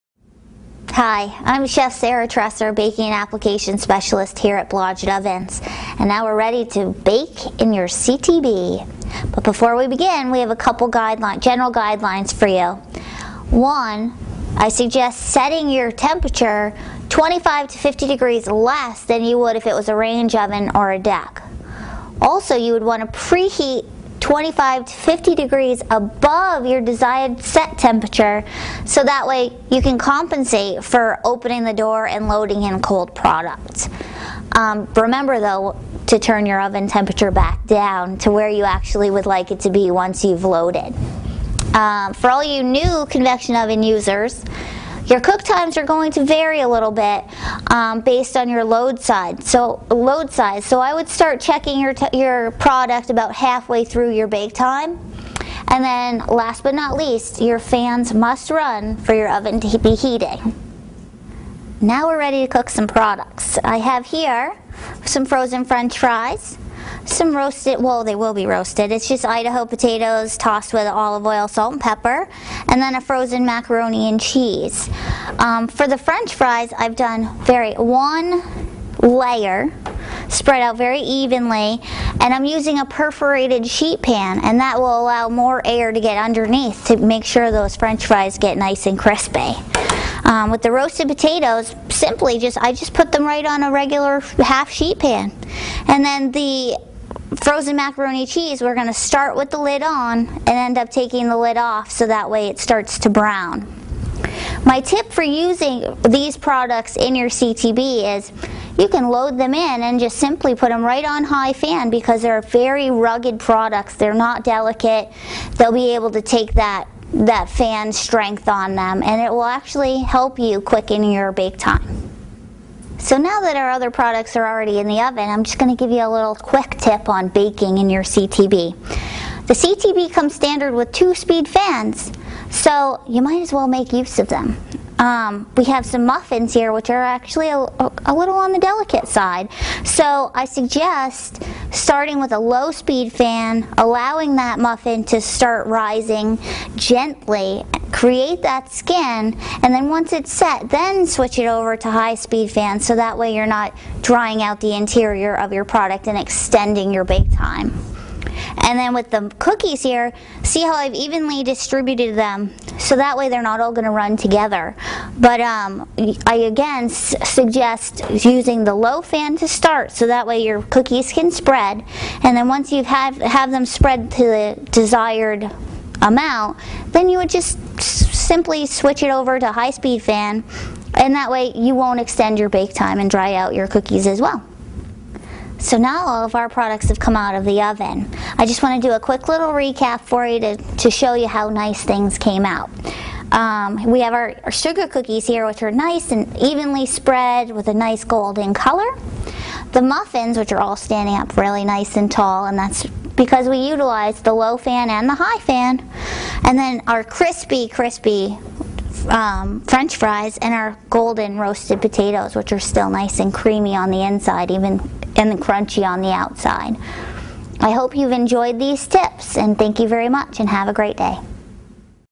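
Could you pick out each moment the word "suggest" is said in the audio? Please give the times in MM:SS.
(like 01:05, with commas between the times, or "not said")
00:14, 02:20, 02:46.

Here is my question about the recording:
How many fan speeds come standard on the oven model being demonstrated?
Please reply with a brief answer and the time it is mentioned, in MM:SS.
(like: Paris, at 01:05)
2, at 02:10.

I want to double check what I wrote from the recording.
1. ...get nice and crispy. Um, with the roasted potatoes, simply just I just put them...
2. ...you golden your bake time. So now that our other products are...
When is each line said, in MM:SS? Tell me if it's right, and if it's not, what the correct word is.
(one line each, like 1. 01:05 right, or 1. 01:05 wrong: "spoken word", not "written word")
1. 01:28 right
2. 02:00 wrong: "quicken", not "golden".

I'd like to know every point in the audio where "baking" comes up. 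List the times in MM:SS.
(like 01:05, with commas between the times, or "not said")
00:02, 02:07.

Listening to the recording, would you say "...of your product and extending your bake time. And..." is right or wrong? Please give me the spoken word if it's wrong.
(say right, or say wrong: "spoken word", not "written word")
right.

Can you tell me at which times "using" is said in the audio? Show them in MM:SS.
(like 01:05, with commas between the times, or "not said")
01:22, 01:45, 02:48.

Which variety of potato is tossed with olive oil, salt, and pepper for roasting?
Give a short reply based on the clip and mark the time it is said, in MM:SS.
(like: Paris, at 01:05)
Idaho, at 01:09.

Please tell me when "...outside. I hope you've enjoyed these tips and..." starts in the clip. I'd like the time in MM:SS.
03:36.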